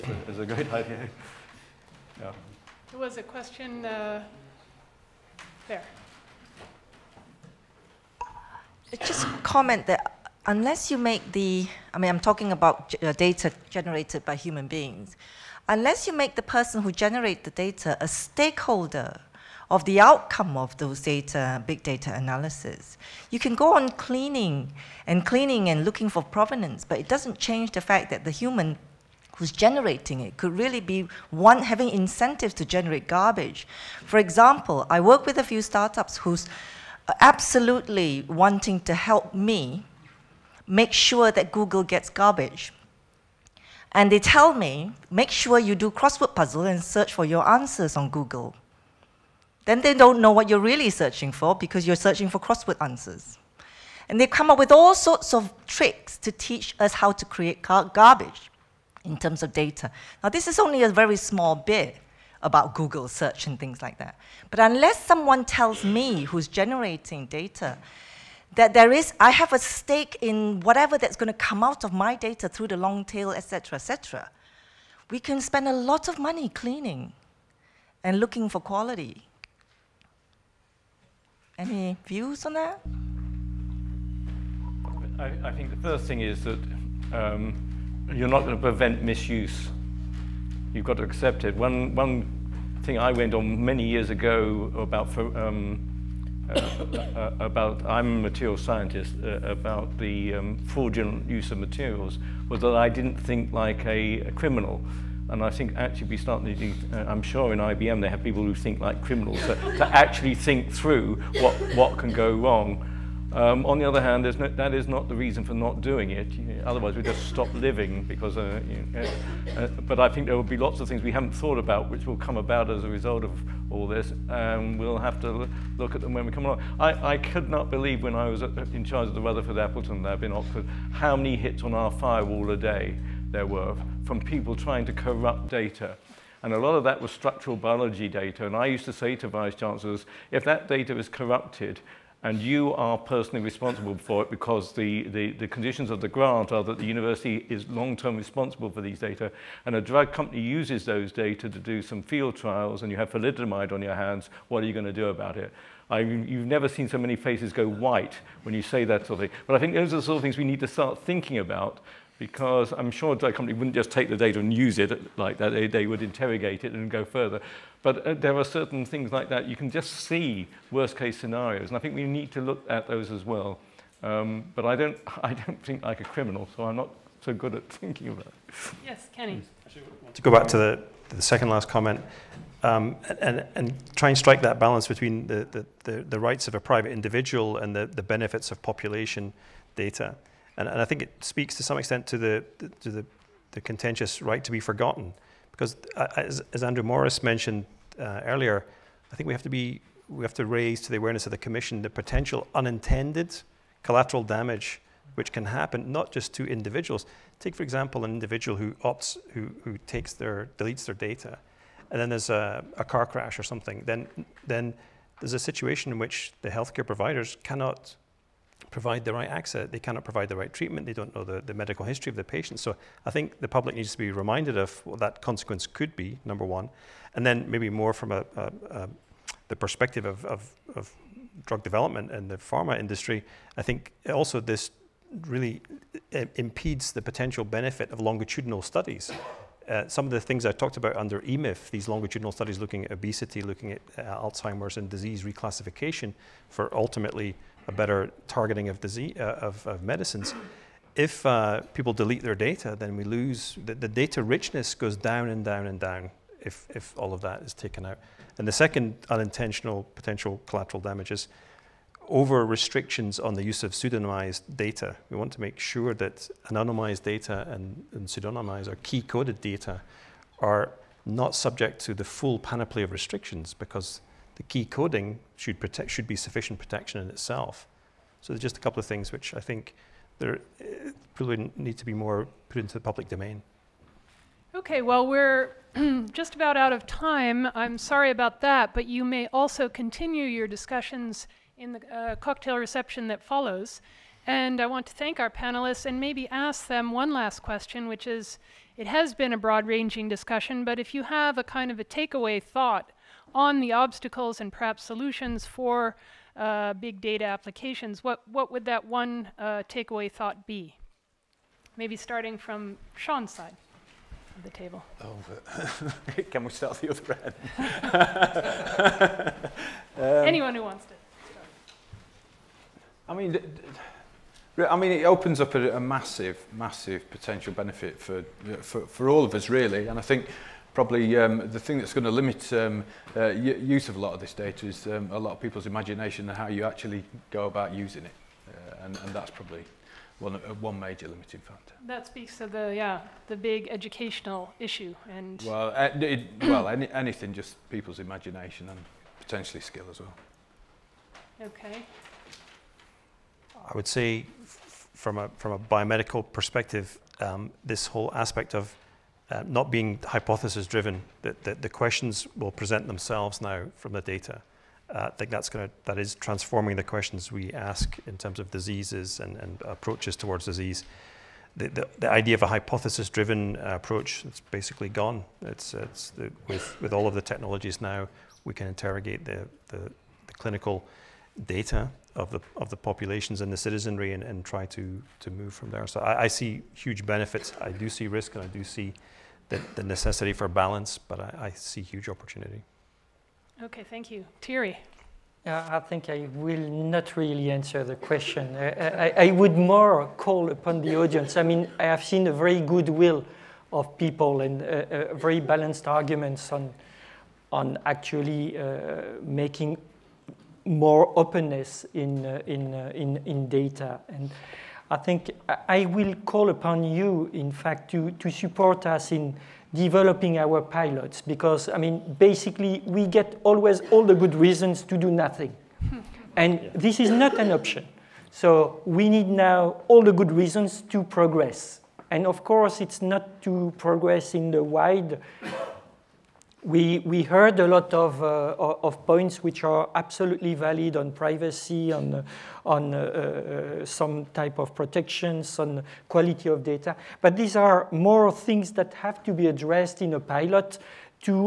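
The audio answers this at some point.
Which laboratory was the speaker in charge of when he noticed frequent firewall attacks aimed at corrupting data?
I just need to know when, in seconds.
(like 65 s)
129 s.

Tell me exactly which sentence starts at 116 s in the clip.
You know, otherwise, we just stop living.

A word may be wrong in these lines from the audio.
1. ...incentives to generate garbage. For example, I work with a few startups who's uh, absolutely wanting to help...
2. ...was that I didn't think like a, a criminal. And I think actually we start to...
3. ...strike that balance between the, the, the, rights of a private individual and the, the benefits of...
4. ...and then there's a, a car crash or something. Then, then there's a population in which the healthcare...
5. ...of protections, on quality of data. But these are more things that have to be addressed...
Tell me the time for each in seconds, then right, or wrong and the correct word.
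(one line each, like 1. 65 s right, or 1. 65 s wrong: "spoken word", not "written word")
1. 31 s right
2. 102 s right
3. 184 s right
4. 211 s wrong: "situation", not "population"
5. 444 s right.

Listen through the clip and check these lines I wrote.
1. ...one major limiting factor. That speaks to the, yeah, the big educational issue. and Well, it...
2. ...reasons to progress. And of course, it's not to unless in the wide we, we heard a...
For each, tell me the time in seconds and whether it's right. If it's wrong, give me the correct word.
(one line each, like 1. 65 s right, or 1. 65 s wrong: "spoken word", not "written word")
1. 340 s right
2. 430 s wrong: "progress", not "unless".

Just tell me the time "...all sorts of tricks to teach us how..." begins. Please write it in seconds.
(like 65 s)
54 s.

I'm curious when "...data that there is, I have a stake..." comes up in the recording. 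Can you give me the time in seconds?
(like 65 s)
67 s.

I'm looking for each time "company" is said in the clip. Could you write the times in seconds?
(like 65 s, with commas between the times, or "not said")
150 s, 163 s.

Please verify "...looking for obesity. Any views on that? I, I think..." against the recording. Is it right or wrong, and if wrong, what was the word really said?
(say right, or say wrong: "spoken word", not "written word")
wrong: "quality", not "obesity".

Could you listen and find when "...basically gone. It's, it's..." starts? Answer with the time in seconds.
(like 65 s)
374 s.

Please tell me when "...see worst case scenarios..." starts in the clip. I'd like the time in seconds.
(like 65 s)
169 s.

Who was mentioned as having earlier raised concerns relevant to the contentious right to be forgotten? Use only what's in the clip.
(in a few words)
Andrew Morris.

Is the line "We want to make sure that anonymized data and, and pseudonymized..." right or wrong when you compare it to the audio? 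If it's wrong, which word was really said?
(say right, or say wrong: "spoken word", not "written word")
right.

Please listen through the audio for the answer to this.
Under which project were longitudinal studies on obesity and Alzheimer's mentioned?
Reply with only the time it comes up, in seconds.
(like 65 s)
241 s.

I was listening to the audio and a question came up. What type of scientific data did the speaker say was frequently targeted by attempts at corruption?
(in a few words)
Structural biology data.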